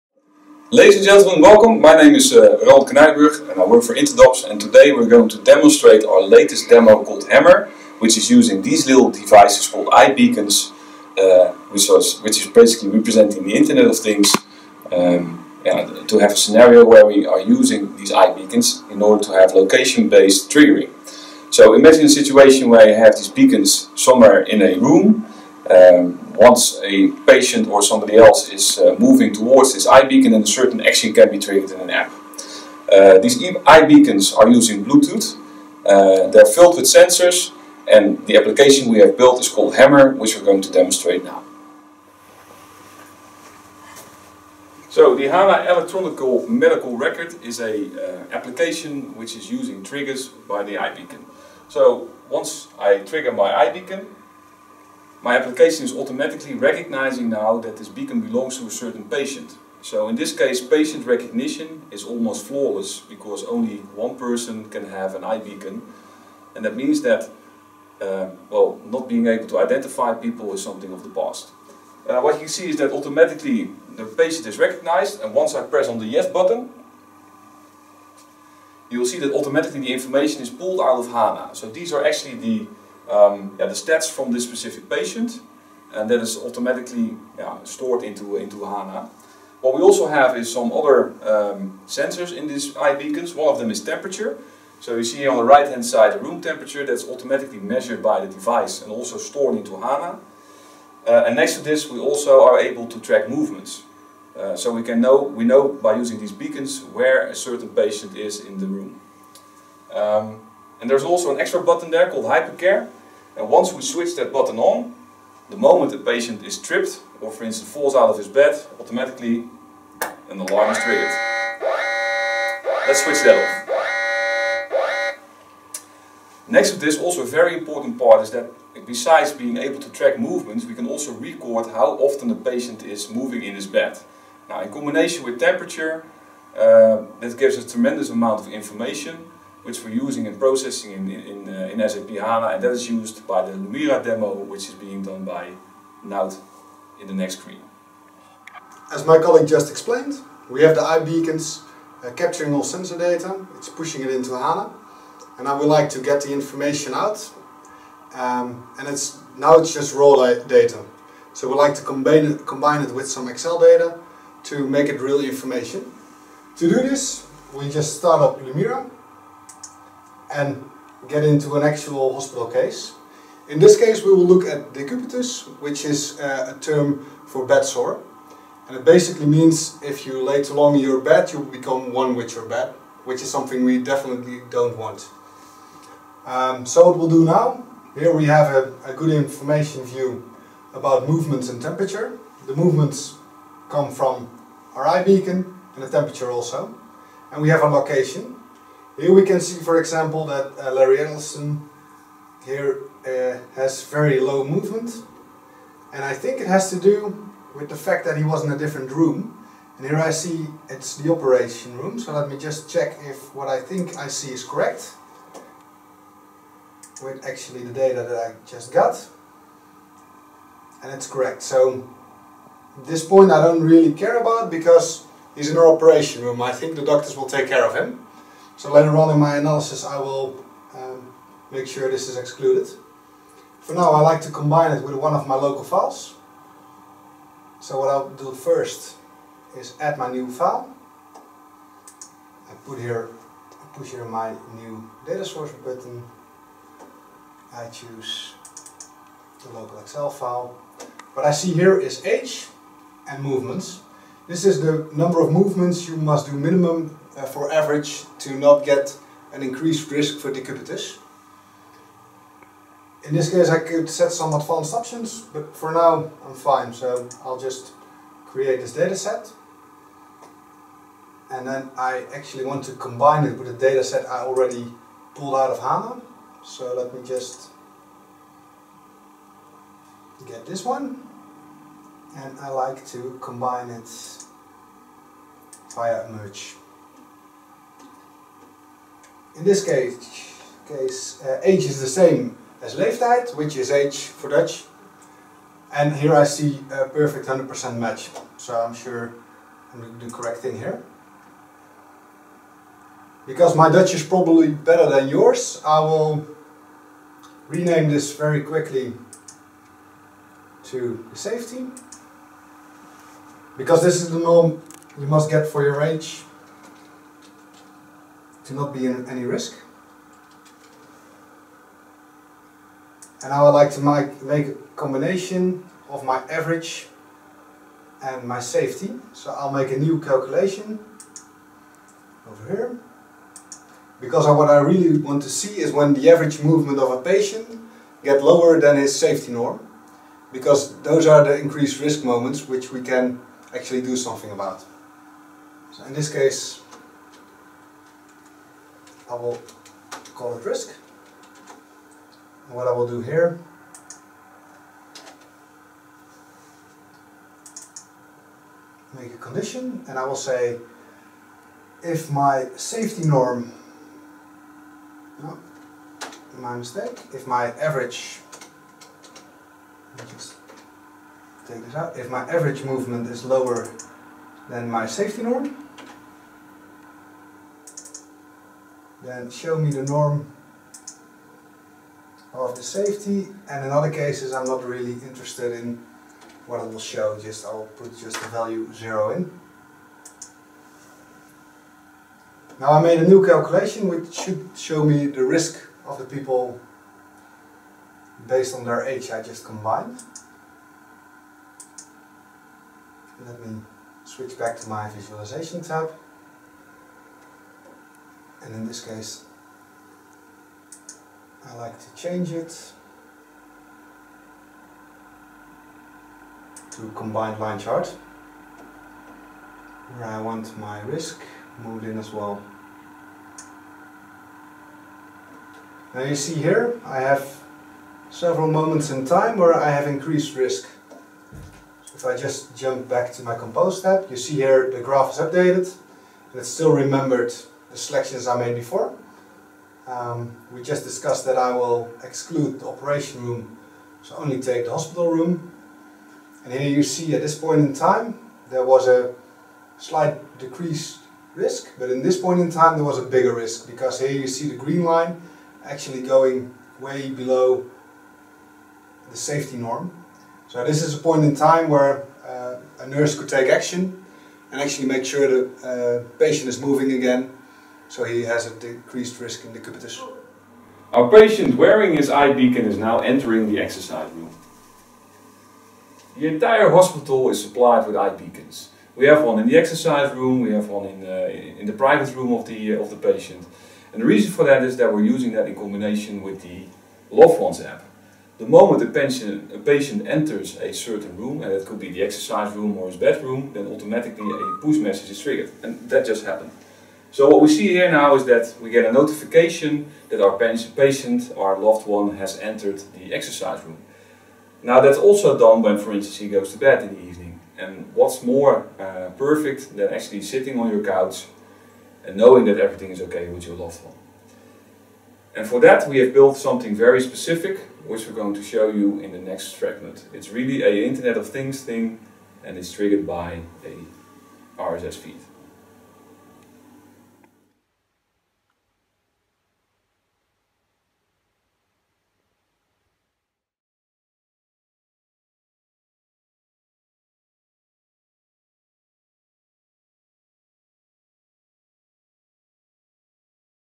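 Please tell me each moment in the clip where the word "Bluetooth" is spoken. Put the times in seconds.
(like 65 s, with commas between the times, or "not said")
34 s.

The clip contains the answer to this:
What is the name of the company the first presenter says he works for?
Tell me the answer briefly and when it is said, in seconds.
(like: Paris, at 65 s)
Interdobs, at 3 s.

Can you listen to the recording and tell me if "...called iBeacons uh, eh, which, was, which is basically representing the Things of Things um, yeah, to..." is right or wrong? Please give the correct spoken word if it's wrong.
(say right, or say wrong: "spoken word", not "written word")
wrong: "Internet", not "Things".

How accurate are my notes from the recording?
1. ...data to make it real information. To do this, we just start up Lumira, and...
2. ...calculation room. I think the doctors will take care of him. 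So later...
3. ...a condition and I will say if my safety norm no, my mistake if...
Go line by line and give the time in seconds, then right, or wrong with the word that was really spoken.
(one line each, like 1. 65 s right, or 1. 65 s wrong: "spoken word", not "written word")
1. 163 s right
2. 225 s wrong: "operation", not "calculation"
3. 359 s right.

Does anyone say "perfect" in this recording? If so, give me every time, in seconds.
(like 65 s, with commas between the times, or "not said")
296 s, 509 s.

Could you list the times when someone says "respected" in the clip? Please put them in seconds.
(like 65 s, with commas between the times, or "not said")
not said.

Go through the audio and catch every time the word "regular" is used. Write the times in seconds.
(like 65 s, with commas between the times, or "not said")
not said.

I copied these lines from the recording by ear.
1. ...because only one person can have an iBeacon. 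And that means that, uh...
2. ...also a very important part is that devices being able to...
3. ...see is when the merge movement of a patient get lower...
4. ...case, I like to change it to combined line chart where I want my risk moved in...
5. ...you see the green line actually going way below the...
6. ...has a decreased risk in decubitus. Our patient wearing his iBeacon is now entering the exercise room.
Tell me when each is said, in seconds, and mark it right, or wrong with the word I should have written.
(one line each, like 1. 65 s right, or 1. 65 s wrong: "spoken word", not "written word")
1. 62 s right
2. 126 s wrong: "besides", not "devices"
3. 335 s wrong: "average", not "merge"
4. 408 s right
5. 454 s right
6. 468 s right.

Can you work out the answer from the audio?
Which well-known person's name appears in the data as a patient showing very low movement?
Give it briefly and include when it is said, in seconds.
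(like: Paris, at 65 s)
Larry Ellison, at 200 s.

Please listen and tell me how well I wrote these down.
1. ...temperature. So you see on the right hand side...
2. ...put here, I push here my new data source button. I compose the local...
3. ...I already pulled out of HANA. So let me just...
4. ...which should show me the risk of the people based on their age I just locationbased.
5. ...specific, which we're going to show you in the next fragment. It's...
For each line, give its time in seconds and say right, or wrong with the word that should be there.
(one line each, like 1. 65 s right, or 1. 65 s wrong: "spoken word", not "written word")
1. 93 s right
2. 242 s wrong: "choose", not "compose"
3. 274 s right
4. 393 s wrong: "combined", not "locationbased"
5. 516 s right.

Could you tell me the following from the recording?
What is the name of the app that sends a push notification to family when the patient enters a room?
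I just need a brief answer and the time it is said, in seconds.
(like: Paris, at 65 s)
Loved Ones, at 487 s.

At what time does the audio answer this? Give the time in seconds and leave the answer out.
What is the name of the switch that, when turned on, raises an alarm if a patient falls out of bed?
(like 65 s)
112 s.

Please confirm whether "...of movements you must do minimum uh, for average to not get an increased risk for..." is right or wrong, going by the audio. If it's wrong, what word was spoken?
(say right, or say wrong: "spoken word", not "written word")
right.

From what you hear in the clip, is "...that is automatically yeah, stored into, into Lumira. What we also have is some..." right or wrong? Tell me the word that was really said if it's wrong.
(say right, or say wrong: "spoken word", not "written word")
wrong: "HANA", not "Lumira".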